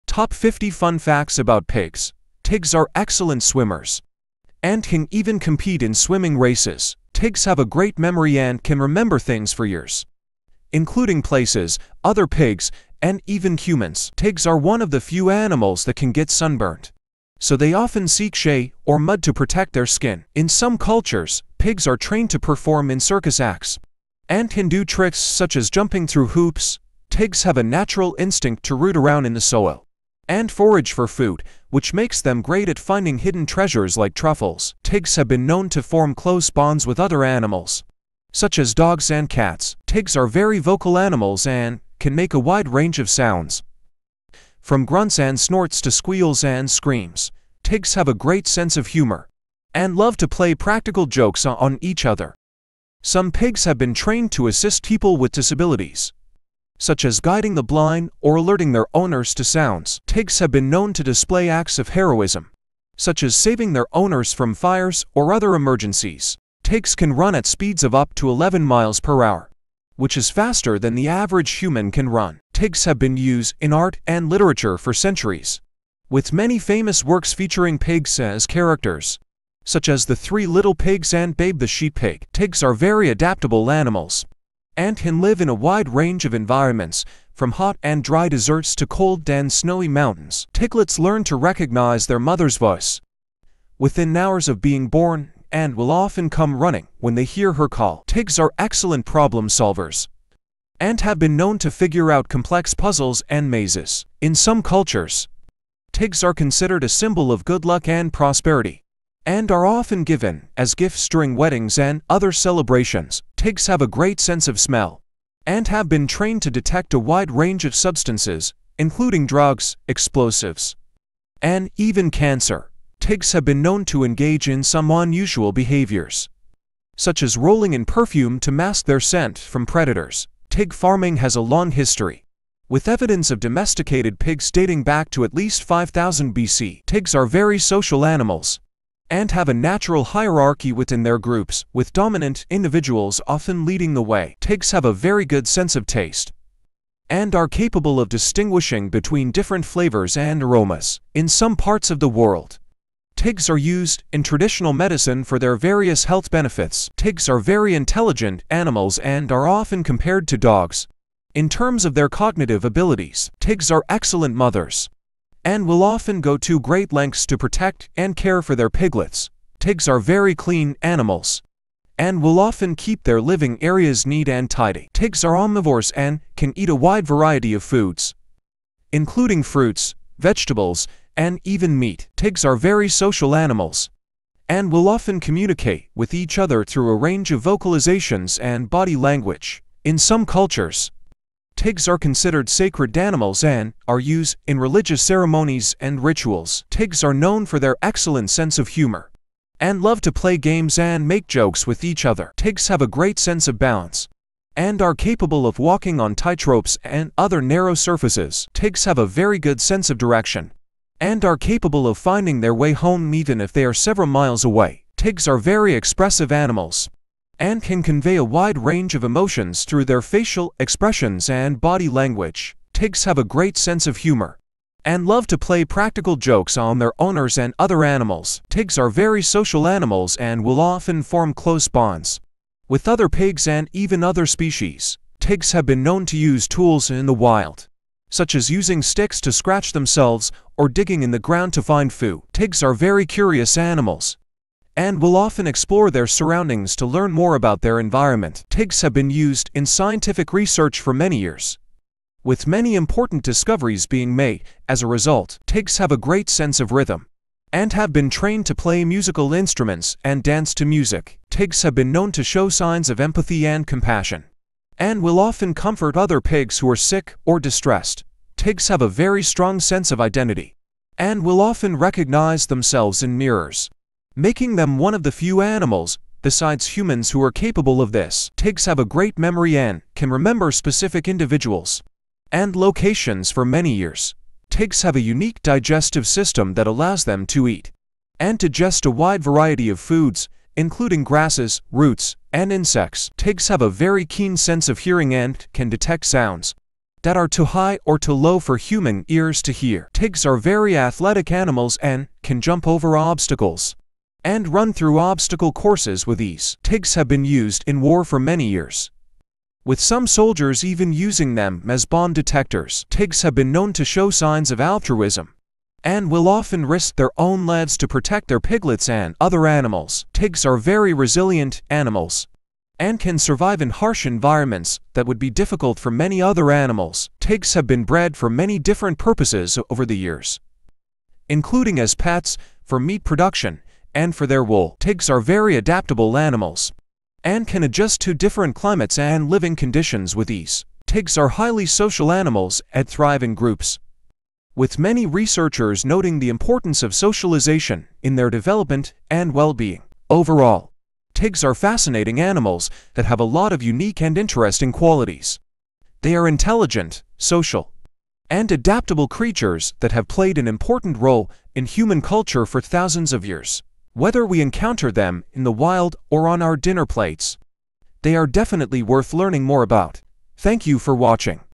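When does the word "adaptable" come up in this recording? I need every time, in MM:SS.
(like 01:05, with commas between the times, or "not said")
01:23, 05:35, 05:58.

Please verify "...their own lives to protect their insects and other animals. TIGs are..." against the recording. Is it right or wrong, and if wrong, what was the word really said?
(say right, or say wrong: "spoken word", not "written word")
wrong: "piglets", not "insects".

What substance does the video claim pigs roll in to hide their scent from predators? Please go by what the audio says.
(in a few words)
Perfume.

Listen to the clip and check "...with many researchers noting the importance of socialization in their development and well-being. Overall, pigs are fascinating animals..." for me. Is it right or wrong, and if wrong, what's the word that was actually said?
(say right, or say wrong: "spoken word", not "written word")
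right.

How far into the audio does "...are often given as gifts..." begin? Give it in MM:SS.
01:49.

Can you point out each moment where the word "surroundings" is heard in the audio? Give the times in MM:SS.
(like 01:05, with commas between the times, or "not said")
04:06.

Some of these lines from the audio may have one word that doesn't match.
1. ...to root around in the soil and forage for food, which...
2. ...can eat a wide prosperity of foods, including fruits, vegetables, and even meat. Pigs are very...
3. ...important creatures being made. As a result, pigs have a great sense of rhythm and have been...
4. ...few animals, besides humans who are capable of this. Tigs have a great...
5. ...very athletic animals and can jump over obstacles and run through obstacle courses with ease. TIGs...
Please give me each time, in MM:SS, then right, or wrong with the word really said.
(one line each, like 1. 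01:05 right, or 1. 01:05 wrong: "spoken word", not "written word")
1. 00:28 right
2. 02:56 wrong: "variety", not "prosperity"
3. 04:12 wrong: "discoveries", not "creatures"
4. 04:35 right
5. 05:00 right.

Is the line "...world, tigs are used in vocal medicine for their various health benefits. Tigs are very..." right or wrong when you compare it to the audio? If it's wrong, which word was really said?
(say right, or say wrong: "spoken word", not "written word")
wrong: "traditional", not "vocal".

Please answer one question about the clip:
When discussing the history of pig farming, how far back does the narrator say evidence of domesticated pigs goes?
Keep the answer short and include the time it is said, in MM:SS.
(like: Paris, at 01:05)
5000 BC, at 02:15.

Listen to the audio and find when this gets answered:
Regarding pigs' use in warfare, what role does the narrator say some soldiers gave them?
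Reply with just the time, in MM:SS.
05:11.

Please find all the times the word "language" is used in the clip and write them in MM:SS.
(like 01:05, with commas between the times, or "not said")
03:08, 03:41.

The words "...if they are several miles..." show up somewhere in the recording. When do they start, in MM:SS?
03:33.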